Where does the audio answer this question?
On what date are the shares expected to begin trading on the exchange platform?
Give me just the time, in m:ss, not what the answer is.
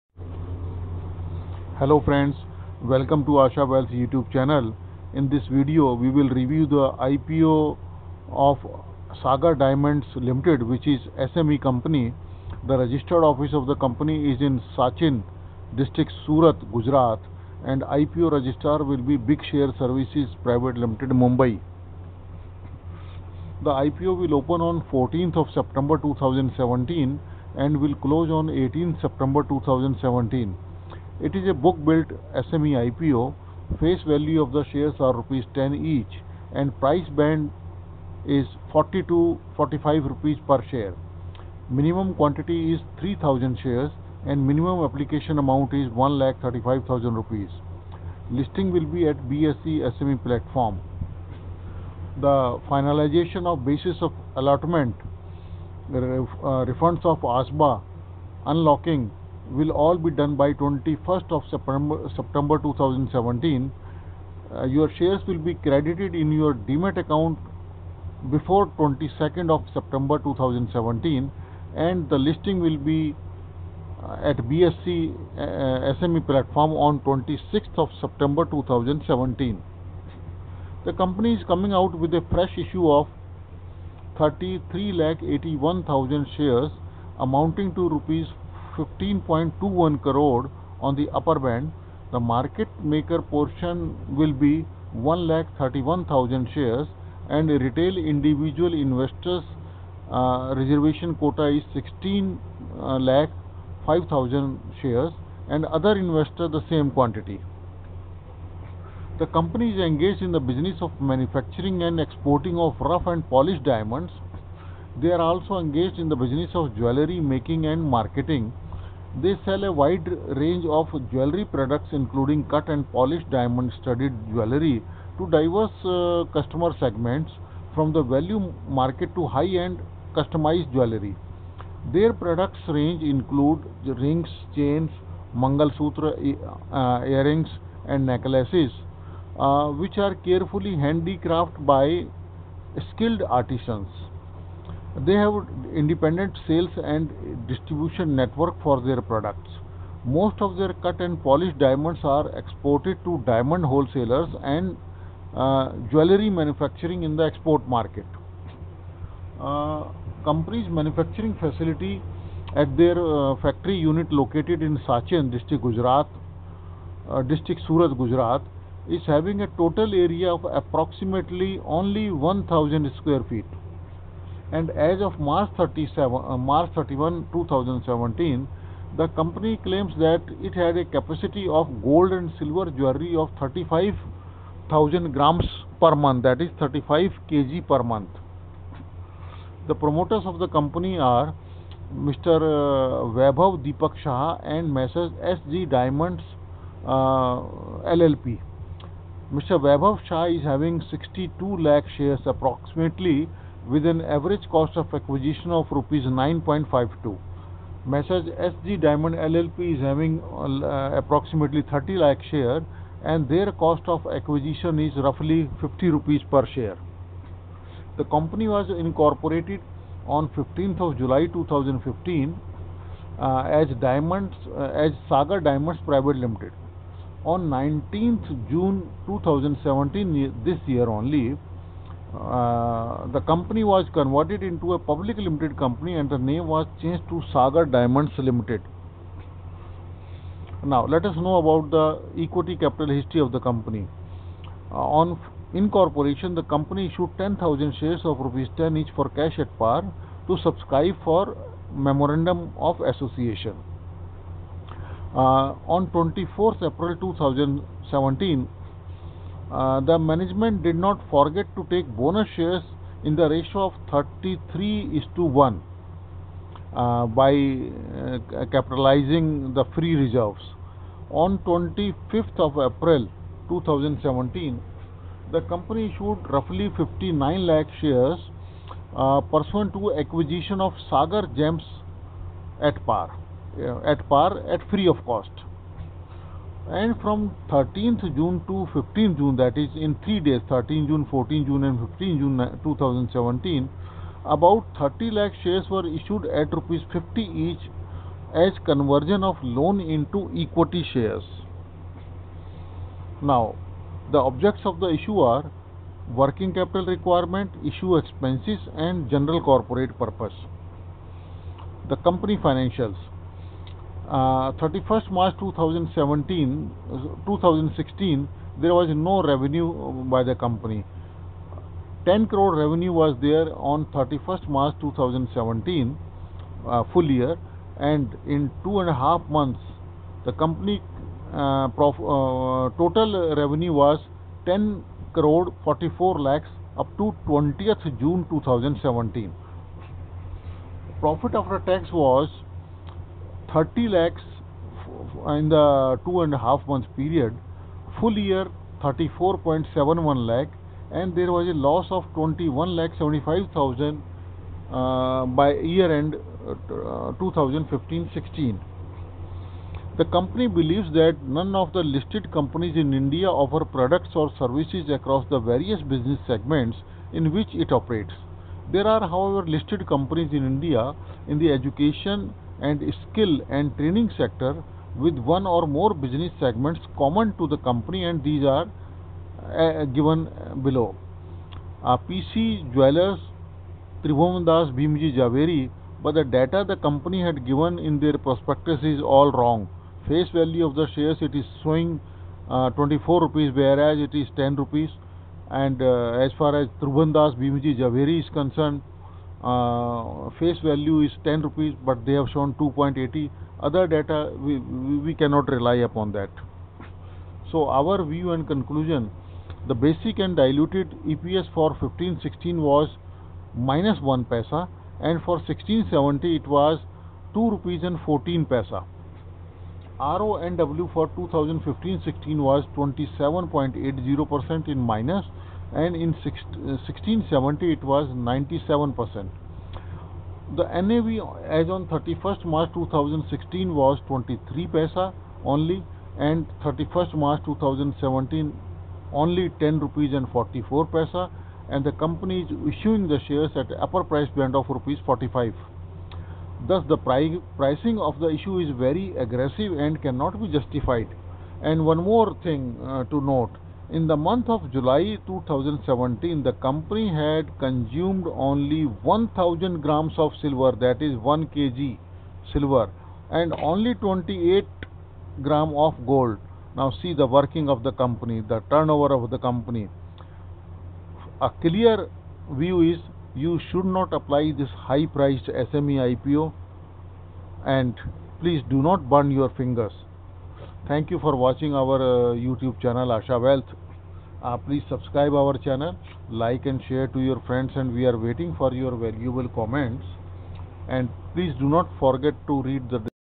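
1:16.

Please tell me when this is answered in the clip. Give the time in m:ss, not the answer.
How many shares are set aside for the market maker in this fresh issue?
1:34.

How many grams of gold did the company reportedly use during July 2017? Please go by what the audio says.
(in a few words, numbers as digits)
28.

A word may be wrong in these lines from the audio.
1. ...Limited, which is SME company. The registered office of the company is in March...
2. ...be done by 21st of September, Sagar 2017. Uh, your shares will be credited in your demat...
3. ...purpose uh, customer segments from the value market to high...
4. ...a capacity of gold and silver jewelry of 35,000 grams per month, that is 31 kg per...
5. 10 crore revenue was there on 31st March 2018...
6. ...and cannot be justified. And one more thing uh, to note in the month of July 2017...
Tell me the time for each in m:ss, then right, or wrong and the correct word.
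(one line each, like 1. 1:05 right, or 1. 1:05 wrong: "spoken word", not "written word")
1. 0:10 wrong: "Sachin", not "March"
2. 0:59 wrong: "September", not "Sagar"
3. 2:05 wrong: "diverse", not "purpose"
4. 3:00 wrong: "35", not "31"
5. 5:22 wrong: "2017", not "2018"
6. 7:29 right.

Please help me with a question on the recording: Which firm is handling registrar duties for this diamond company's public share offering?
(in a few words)
Big Share Services Private Limited.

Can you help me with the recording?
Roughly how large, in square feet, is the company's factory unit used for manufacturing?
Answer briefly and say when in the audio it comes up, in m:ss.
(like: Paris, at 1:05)
1000, at 2:52.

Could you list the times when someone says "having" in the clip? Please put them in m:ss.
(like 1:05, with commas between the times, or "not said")
2:49, 3:20, 3:29.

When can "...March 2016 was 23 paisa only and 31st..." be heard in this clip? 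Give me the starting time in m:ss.
7:12.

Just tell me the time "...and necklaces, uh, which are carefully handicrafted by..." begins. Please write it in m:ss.
2:17.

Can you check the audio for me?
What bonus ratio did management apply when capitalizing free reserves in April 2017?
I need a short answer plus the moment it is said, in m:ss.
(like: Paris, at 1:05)
33:1, at 4:23.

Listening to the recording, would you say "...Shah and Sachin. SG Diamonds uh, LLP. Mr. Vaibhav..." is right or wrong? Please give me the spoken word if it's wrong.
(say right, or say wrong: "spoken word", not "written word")
wrong: "Messrs", not "Sachin".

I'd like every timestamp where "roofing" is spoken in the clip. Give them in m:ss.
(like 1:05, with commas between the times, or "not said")
not said.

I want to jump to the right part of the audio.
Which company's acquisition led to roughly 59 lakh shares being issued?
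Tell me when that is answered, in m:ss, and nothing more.
4:40.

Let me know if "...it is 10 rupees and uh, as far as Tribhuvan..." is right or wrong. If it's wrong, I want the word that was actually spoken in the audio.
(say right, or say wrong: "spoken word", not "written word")
right.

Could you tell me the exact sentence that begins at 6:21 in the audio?
Uh, PC Jewelers Tribhuvan Bhimji Javeri but the data the company had given in their prospectus is all wrong.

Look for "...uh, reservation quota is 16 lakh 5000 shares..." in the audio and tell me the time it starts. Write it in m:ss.
1:40.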